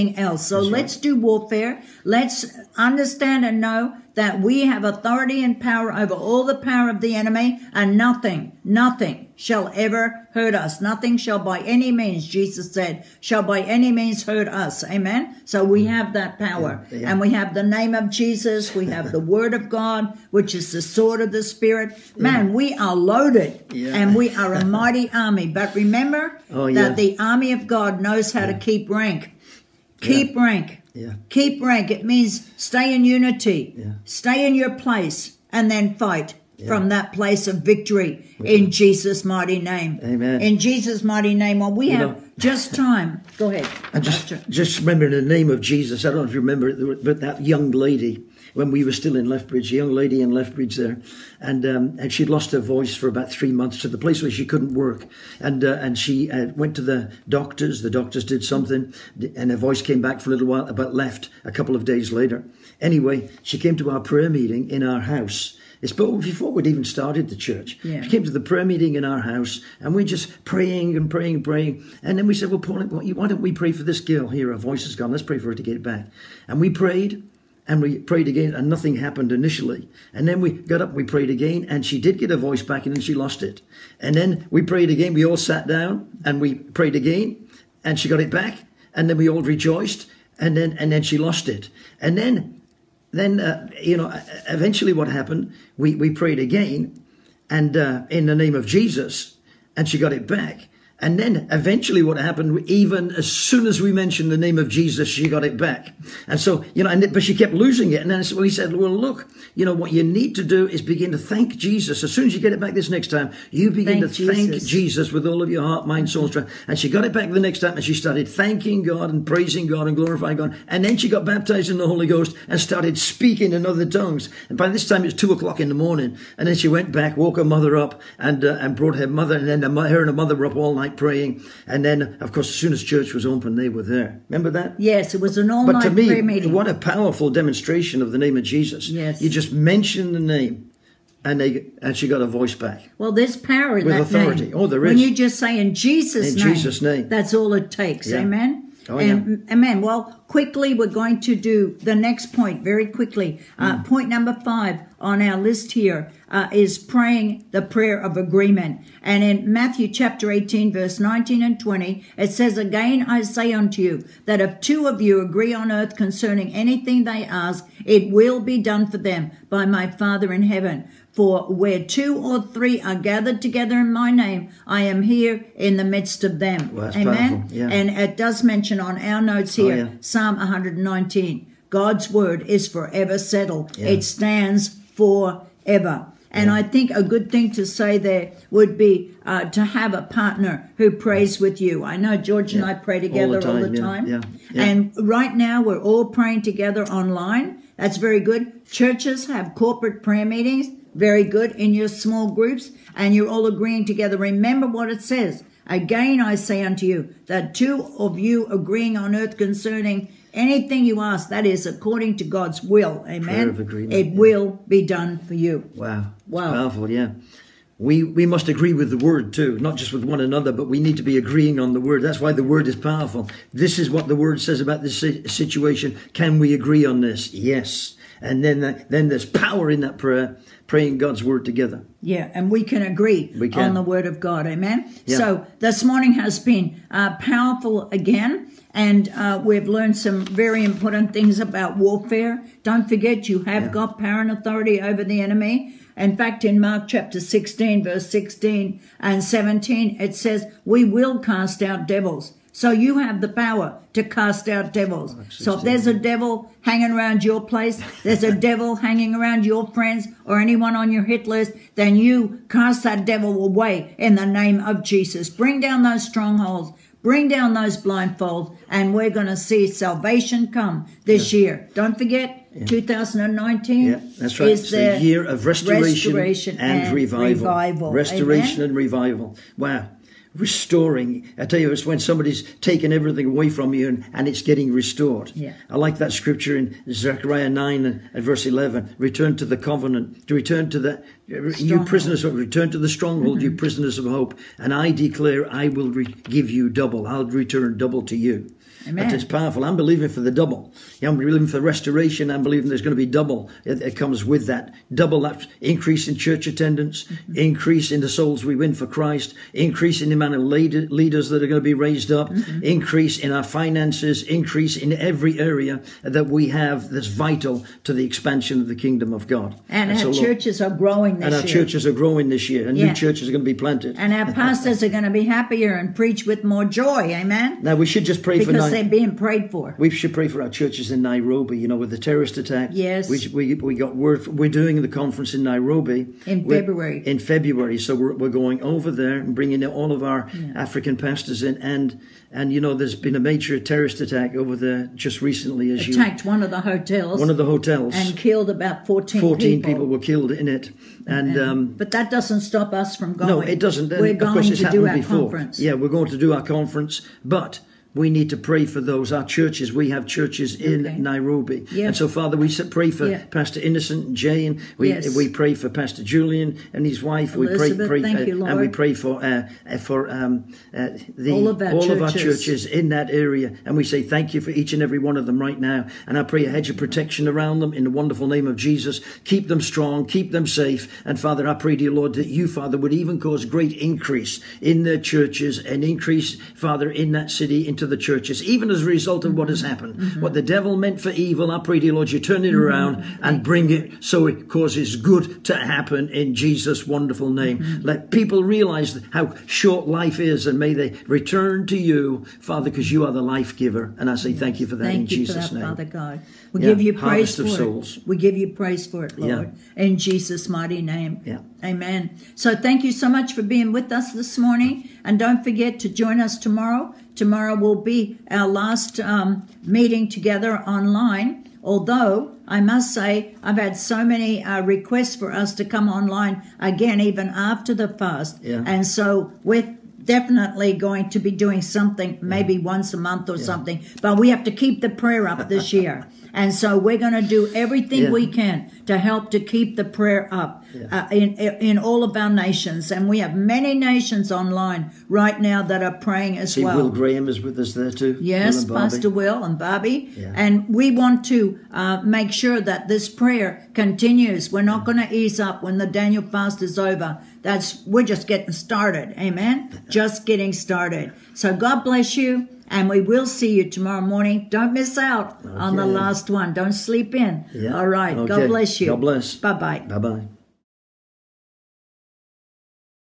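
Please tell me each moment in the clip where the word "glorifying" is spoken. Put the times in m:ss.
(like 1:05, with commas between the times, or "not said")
1:59.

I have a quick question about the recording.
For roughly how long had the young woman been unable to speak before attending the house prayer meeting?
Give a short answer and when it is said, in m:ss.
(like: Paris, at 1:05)
3 months, at 0:53.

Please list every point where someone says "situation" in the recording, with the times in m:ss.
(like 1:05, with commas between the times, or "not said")
3:44.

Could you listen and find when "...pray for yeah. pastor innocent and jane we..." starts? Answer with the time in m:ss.
6:02.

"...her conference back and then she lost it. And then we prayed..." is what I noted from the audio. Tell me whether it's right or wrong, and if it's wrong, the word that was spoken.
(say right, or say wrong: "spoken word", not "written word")
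wrong: "voice", not "conference".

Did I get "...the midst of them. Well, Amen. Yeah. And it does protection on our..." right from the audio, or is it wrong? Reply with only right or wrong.
wrong.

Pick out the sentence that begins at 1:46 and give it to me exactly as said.
And so, you know, and, but she kept losing it.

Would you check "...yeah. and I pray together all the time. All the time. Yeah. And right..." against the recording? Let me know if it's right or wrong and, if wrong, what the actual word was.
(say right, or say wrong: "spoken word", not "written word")
right.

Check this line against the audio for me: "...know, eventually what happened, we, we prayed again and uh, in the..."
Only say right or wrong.
right.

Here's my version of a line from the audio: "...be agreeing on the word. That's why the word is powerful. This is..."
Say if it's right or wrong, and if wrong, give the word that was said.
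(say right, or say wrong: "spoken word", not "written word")
right.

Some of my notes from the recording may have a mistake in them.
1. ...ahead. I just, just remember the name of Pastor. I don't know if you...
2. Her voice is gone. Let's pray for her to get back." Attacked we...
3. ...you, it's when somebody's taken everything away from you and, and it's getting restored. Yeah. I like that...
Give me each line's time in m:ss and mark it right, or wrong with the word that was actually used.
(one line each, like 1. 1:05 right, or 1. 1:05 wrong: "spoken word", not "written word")
1. 0:43 wrong: "Jesus", not "Pastor"
2. 1:14 wrong: "And", not "Attacked"
3. 4:41 right.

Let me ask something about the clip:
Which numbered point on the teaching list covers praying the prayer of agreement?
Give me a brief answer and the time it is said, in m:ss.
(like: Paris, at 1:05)
5, at 2:34.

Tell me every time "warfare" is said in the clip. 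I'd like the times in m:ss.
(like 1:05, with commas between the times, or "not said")
0:01, 4:01.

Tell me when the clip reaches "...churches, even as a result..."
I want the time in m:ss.
6:27.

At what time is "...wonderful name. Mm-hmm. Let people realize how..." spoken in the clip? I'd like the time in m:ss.
6:36.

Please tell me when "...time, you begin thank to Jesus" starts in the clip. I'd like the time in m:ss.
1:53.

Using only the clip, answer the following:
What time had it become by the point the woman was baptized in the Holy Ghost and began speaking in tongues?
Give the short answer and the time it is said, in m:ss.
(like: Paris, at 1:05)
2 o'clock in the morning, at 2:05.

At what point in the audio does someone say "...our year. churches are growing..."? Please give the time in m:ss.
5:21.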